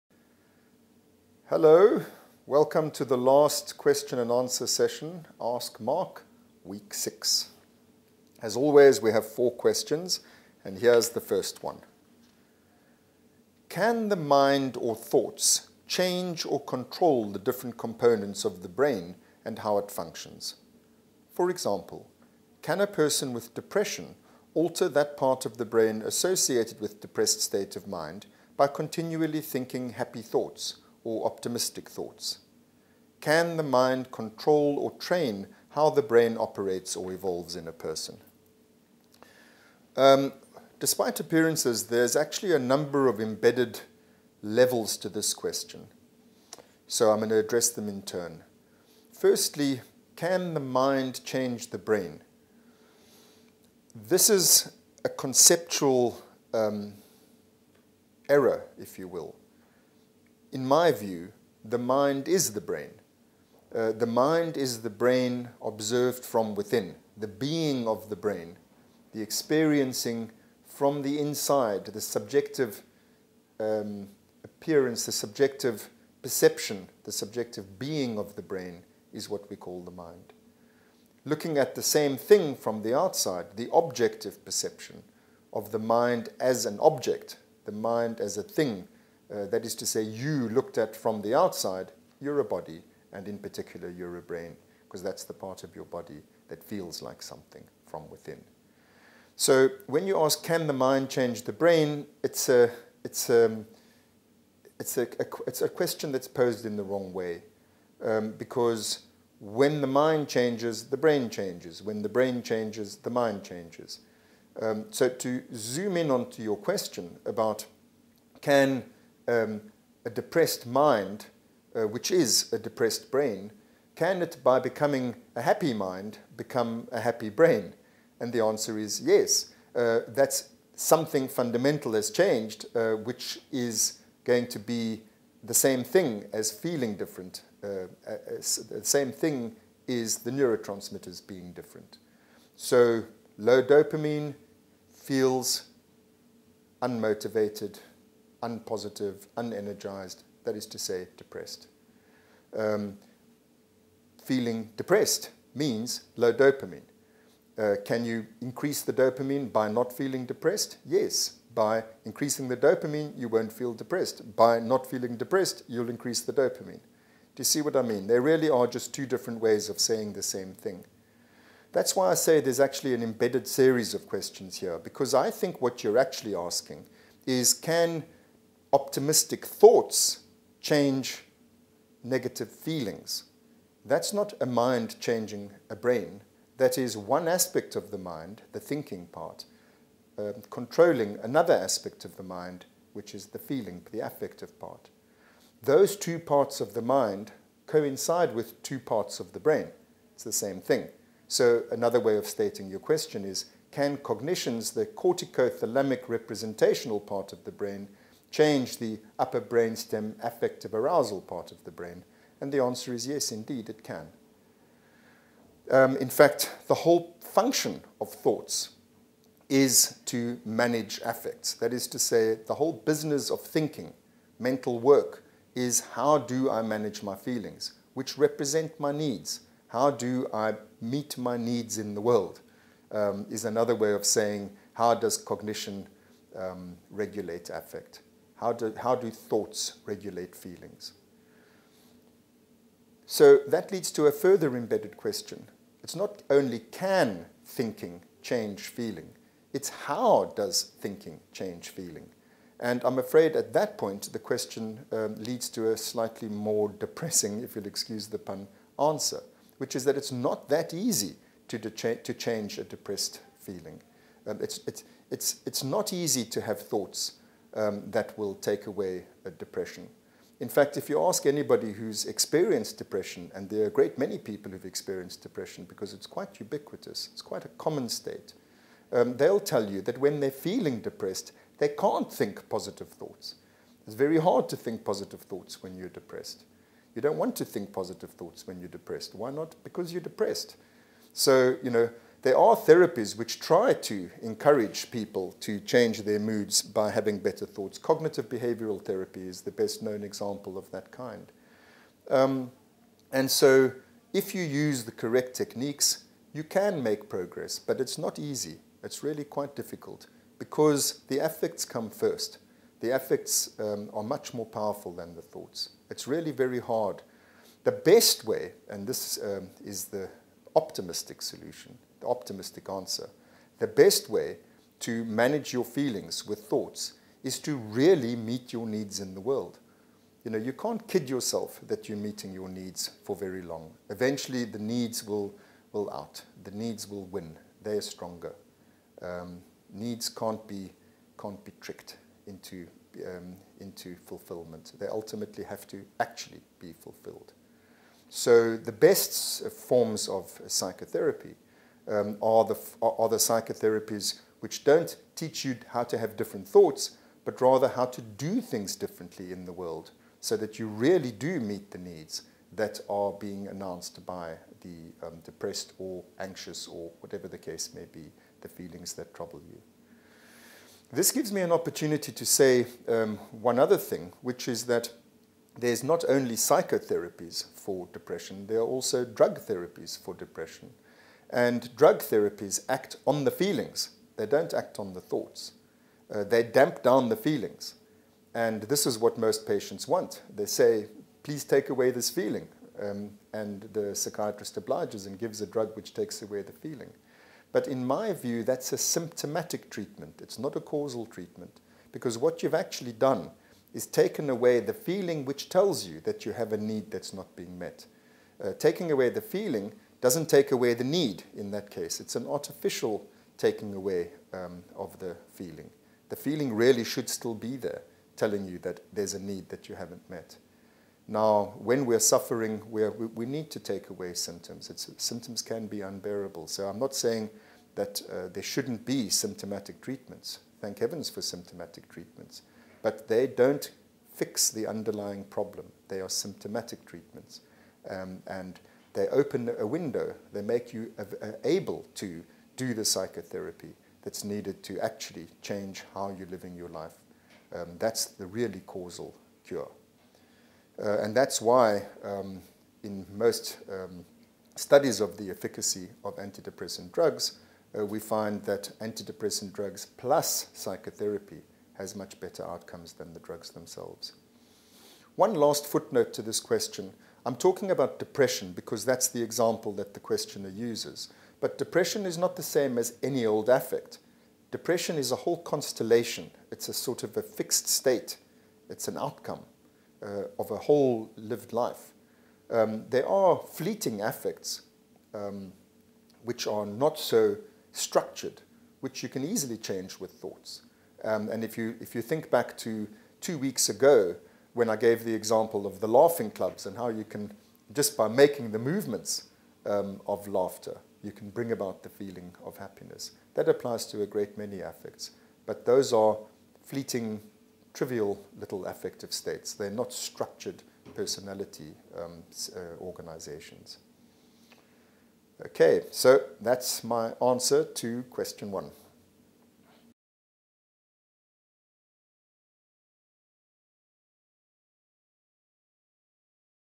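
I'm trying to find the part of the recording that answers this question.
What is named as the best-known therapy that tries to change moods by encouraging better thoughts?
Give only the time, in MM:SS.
04:57.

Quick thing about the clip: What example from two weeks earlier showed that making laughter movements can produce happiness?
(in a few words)
laughing clubs.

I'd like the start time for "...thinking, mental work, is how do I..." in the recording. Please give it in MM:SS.
03:43.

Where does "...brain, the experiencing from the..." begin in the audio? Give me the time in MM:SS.
01:08.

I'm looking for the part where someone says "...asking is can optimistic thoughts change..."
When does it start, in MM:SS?
02:56.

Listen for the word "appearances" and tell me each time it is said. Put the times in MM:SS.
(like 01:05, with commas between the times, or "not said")
00:41, 01:14.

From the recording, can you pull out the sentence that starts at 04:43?
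It's very hard to think positive thoughts when you're depressed.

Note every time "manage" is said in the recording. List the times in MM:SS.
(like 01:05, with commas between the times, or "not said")
03:40, 03:46, 05:25.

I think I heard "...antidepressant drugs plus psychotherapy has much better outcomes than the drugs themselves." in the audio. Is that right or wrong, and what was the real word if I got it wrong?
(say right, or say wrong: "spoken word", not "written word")
right.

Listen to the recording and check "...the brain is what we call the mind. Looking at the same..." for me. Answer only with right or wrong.
right.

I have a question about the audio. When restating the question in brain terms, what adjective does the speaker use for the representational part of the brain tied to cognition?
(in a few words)
corticothalamic.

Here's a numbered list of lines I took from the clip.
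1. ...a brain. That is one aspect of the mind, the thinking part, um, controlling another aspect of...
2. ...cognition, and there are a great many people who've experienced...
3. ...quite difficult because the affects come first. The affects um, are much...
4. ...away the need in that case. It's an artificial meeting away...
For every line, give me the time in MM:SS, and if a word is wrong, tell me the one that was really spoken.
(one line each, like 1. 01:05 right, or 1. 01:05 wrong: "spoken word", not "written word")
1. 03:05 right
2. 04:32 wrong: "depression", not "cognition"
3. 05:09 right
4. 06:50 wrong: "taking", not "meeting".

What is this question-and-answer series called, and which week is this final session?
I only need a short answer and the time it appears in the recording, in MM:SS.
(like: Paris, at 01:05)
Ask Mark, week six, at 00:05.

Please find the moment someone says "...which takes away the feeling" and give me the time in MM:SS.
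06:35.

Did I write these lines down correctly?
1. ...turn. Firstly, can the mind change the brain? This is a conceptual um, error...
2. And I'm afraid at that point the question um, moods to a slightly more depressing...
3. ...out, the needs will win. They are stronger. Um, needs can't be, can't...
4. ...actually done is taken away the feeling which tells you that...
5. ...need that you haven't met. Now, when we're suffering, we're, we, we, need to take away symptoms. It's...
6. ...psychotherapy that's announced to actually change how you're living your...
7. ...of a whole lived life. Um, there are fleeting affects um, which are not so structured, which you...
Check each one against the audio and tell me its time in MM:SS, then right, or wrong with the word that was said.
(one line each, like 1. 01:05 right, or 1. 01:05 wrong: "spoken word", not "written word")
1. 00:48 right
2. 04:12 wrong: "leads", not "moods"
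3. 05:35 right
4. 06:42 right
5. 06:59 right
6. 07:22 wrong: "needed", not "announced"
7. 08:00 right.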